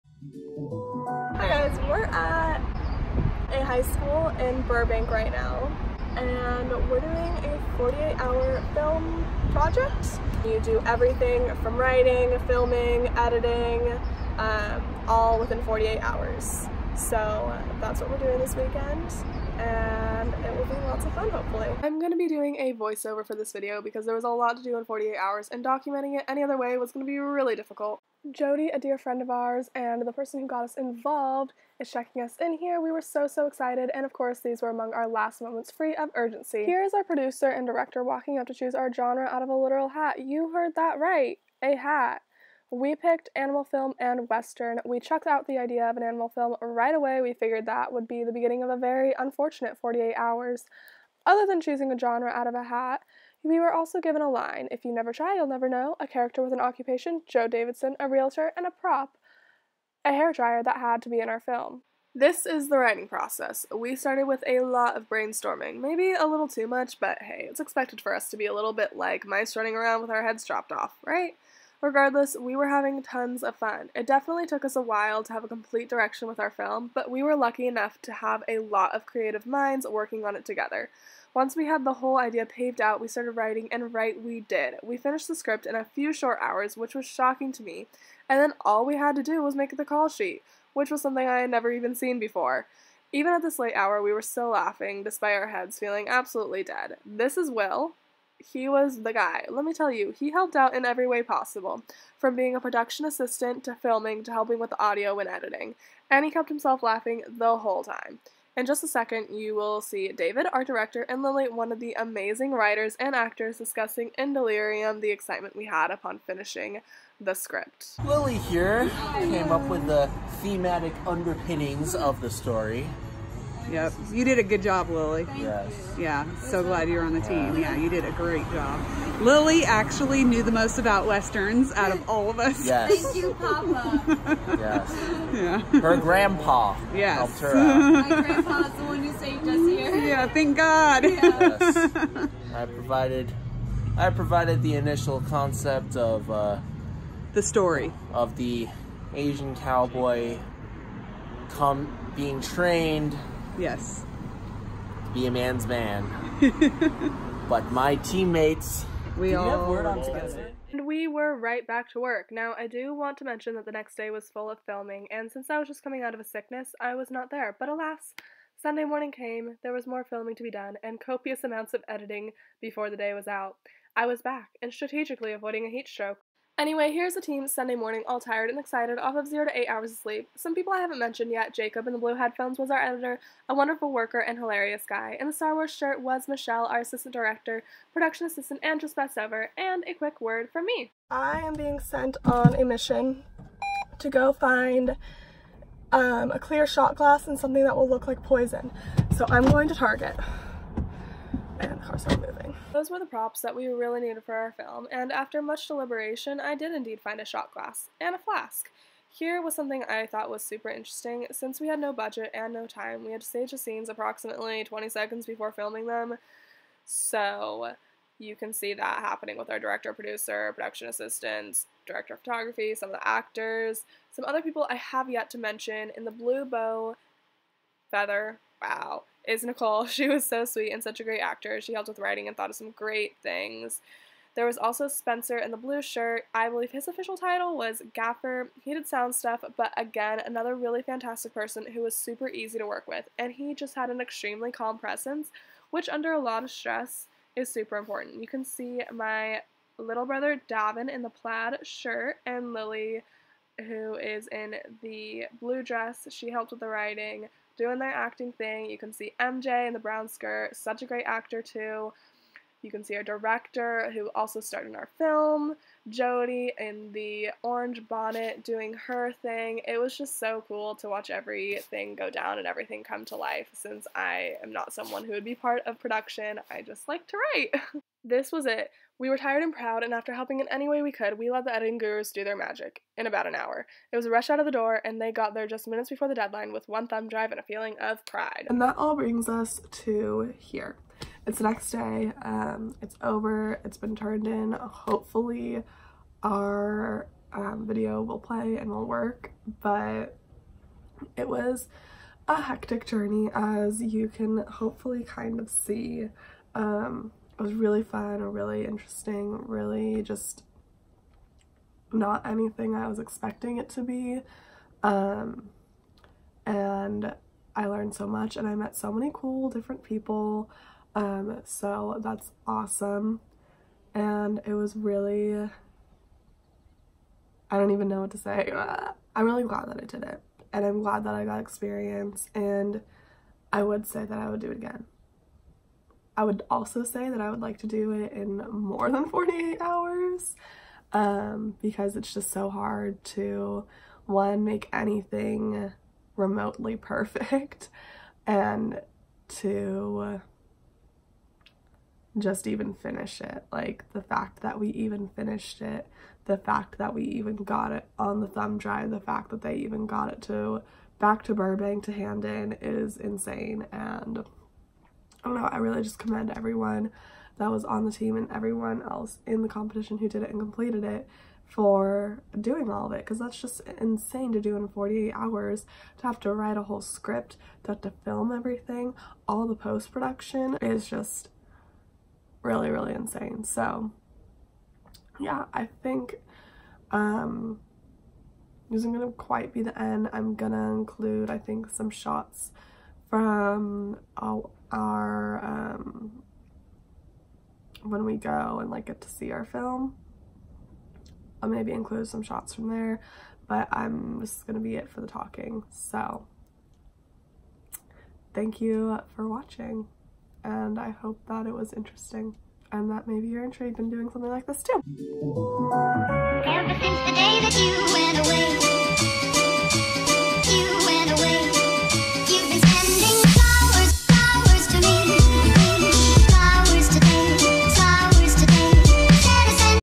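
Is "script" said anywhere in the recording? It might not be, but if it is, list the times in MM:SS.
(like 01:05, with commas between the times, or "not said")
01:25, 01:57, 06:16.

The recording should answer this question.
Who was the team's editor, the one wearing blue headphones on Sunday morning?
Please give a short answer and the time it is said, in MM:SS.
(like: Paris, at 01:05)
Jacob, at 03:01.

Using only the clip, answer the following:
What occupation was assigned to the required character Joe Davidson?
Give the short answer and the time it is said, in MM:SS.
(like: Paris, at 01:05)
Realtor, at 00:57.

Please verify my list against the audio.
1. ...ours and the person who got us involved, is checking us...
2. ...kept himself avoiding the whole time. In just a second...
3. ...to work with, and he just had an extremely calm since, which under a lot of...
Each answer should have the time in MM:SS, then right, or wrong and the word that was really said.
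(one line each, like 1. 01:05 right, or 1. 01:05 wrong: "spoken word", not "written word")
1. 00:29 right
2. 01:46 wrong: "laughing", not "avoiding"
3. 04:02 wrong: "presence", not "since".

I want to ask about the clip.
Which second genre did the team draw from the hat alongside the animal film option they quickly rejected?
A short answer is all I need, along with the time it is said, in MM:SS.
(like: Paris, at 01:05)
Western, at 00:44.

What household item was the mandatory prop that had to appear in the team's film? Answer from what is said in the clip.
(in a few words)
Hair dryer.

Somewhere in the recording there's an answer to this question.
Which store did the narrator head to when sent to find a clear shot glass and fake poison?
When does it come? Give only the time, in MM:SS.
03:19.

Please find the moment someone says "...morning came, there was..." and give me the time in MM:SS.
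02:48.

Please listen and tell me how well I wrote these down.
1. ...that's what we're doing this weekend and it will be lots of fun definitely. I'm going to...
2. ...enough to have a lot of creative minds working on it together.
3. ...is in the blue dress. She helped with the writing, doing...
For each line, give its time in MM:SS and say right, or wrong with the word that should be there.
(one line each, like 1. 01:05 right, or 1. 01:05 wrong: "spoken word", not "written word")
1. 00:17 wrong: "hopefully", not "definitely"
2. 01:17 right
3. 04:13 right.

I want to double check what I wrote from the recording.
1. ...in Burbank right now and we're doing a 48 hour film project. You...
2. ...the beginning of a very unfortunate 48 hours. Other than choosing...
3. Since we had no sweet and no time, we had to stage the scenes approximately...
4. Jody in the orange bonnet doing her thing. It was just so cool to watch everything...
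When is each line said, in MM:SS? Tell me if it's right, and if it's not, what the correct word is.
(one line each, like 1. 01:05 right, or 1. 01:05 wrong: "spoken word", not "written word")
1. 00:04 right
2. 00:48 right
3. 03:31 wrong: "budget", not "sweet"
4. 04:25 right.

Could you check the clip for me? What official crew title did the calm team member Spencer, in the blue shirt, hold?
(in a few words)
Gaffer.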